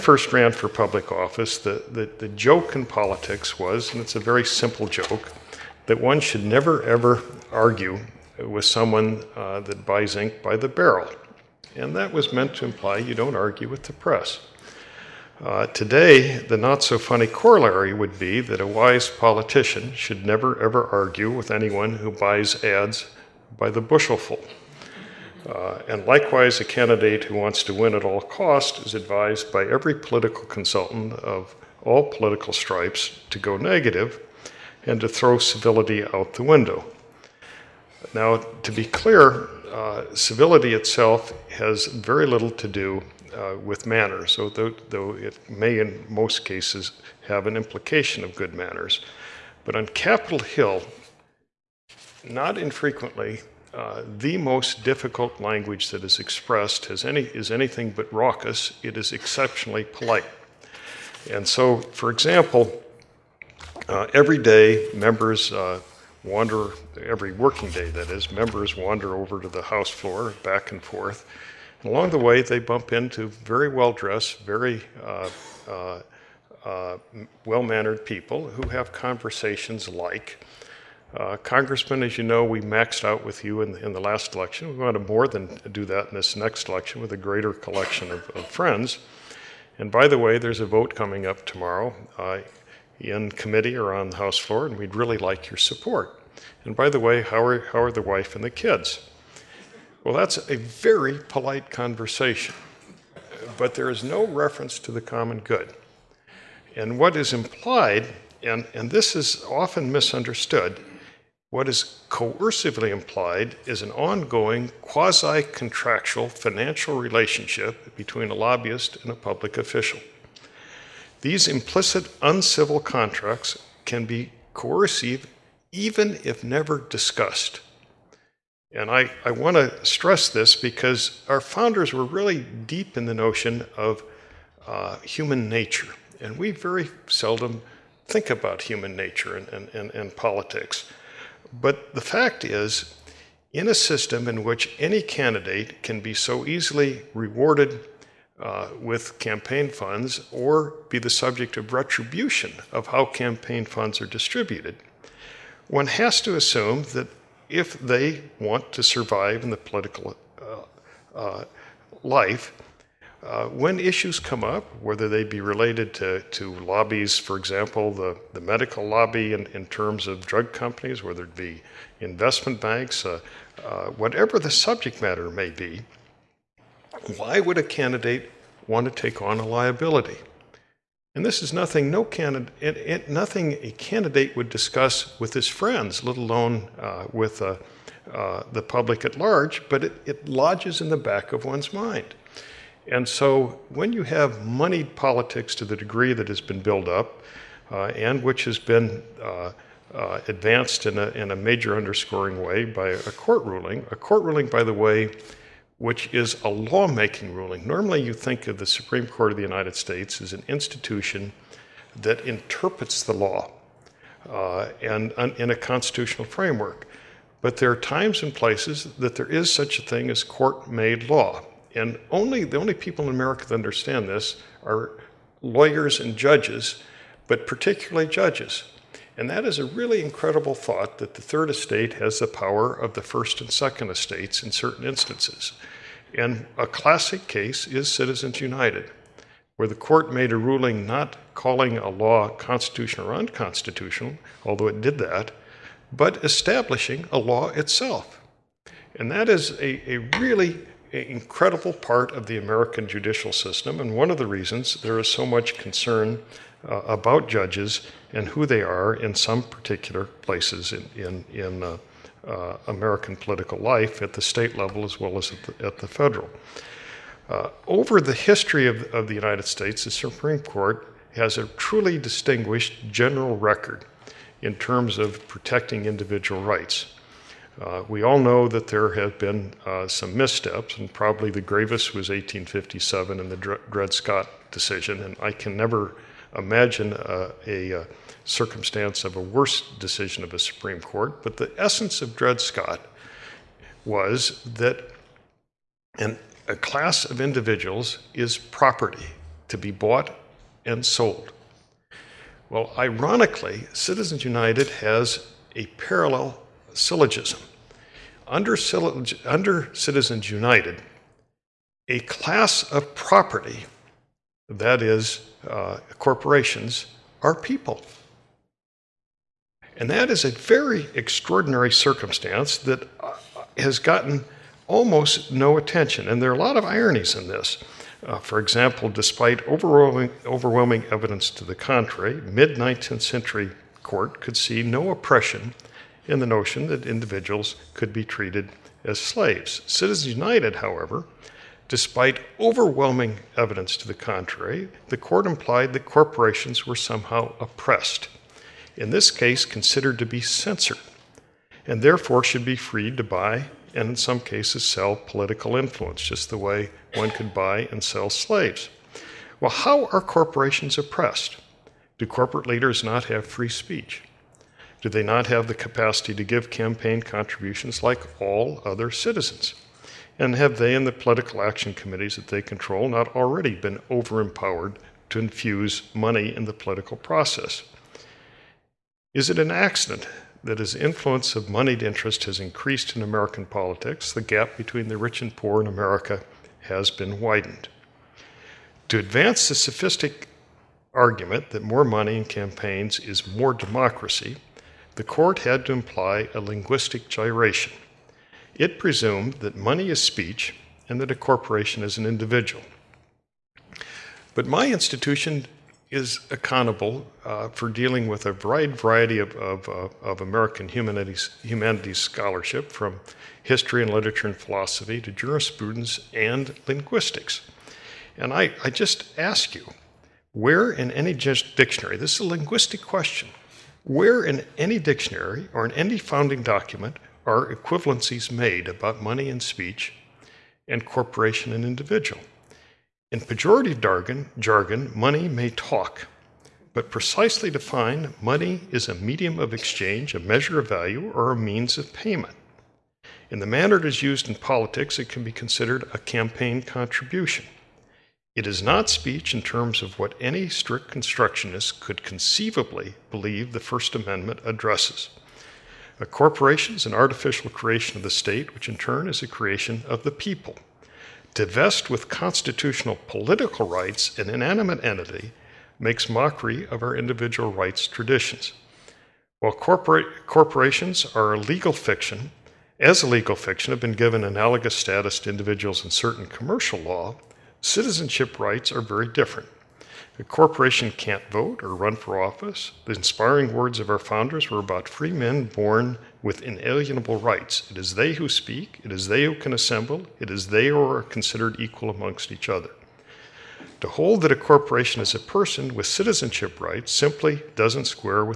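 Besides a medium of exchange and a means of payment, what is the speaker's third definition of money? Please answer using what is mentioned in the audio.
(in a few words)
A measure of value.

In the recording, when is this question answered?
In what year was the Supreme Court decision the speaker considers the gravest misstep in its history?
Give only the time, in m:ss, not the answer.
4:42.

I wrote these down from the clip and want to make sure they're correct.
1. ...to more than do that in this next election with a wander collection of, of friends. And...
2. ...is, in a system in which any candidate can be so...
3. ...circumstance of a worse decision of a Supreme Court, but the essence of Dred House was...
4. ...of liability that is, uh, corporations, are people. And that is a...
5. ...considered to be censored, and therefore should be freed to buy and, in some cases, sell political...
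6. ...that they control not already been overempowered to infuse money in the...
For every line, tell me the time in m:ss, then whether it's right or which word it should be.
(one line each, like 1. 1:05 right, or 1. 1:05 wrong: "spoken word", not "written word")
1. 1:24 wrong: "greater", not "wander"
2. 2:22 right
3. 4:48 wrong: "Scott", not "House"
4. 5:12 wrong: "property", not "liability"
5. 5:49 right
6. 6:12 right.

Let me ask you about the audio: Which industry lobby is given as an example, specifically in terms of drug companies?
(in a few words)
The medical lobby.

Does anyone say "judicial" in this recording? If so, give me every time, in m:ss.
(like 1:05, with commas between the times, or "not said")
4:12.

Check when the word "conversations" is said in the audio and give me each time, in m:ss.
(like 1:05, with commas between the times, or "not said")
1:18, 1:41.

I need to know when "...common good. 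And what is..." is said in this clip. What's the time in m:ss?
1:45.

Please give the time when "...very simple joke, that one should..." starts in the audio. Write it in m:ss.
0:04.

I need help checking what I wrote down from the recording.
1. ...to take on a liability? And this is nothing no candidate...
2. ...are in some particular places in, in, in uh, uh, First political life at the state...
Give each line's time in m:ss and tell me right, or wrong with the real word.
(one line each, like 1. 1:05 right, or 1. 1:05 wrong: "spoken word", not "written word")
1. 2:58 right
2. 4:18 wrong: "American", not "First".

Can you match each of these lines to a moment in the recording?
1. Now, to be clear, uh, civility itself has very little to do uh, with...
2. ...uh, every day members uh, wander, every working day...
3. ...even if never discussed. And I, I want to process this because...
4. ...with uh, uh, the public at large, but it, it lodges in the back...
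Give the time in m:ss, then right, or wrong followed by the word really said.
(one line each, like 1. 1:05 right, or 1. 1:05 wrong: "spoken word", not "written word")
1. 0:38 right
2. 1:03 right
3. 2:05 wrong: "stress", not "process"
4. 3:07 right.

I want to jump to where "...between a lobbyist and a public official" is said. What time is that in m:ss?
1:57.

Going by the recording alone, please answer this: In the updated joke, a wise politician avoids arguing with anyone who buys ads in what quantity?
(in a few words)
By the bushelful.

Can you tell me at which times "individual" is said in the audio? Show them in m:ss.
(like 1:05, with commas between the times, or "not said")
4:35, 4:57, 5:36, 6:42, 7:11, 7:46, 7:55.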